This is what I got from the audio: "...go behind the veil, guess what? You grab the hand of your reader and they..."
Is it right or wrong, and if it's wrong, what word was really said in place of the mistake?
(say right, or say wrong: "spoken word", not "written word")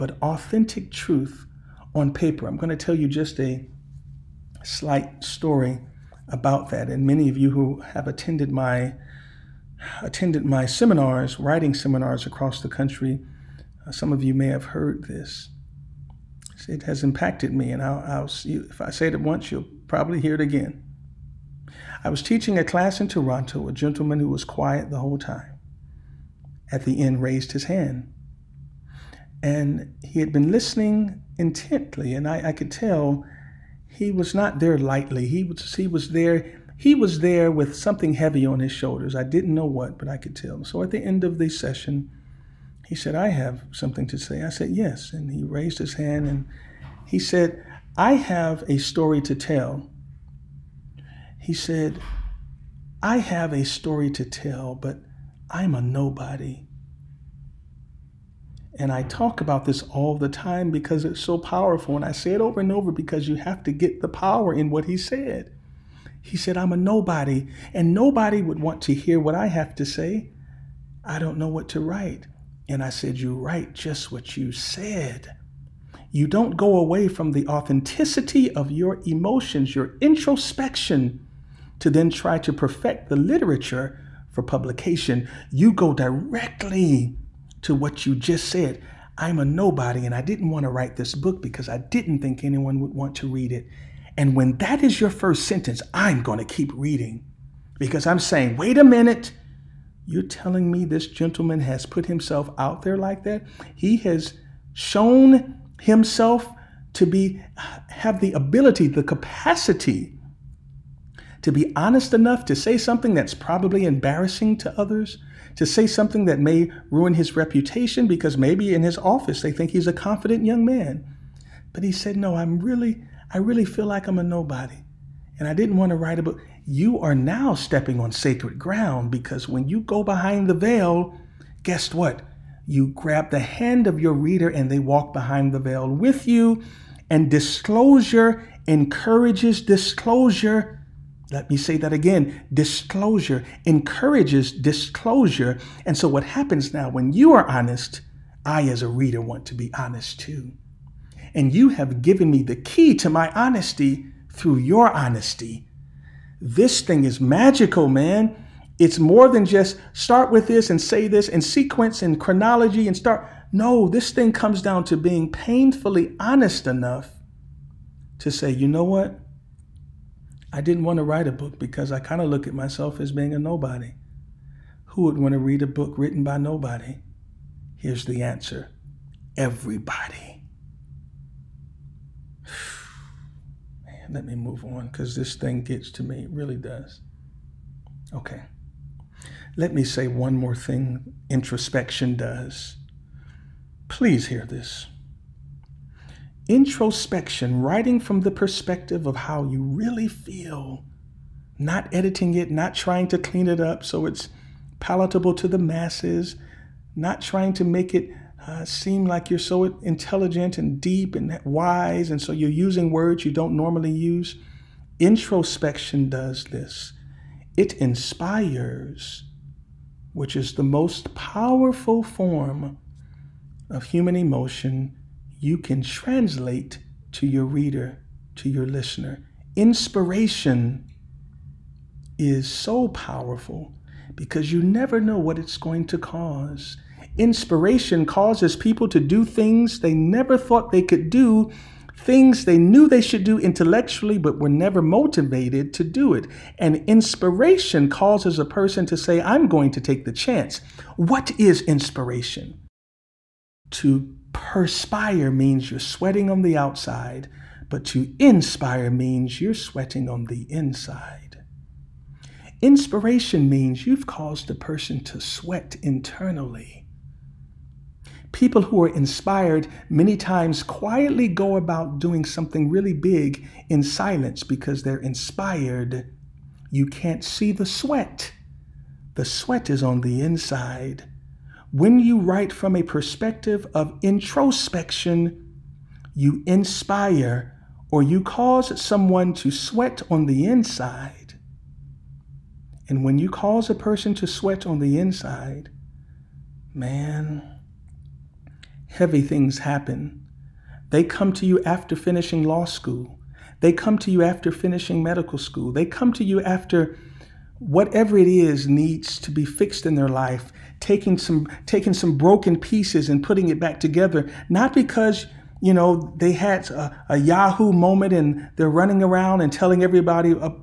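right.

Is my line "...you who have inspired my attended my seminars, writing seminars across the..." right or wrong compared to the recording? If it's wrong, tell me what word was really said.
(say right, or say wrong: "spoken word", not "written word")
wrong: "attended", not "inspired".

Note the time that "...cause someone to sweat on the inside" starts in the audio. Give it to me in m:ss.
4:48.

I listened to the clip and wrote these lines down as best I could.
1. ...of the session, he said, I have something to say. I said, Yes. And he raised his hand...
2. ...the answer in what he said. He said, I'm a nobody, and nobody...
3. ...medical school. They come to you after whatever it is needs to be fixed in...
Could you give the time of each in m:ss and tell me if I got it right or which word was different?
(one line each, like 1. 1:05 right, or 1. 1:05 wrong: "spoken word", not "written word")
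1. 0:41 right
2. 1:03 wrong: "power", not "answer"
3. 5:05 right.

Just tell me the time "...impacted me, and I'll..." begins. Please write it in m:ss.
0:17.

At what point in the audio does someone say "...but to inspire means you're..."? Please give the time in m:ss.
4:17.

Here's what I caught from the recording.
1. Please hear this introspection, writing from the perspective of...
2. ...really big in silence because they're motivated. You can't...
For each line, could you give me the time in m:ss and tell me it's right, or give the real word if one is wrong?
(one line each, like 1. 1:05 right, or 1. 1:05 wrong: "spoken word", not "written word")
1. 3:13 right
2. 4:32 wrong: "inspired", not "motivated".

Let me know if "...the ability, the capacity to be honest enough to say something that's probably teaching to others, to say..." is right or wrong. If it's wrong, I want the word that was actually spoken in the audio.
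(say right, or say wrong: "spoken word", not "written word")
wrong: "embarrassing", not "teaching".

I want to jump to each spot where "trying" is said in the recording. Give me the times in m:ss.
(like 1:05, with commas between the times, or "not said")
3:22, 3:27.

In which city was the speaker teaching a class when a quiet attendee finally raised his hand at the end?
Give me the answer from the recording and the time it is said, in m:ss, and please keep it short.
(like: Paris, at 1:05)
Toronto, at 0:23.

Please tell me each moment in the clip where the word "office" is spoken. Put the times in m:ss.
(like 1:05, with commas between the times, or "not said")
1:58.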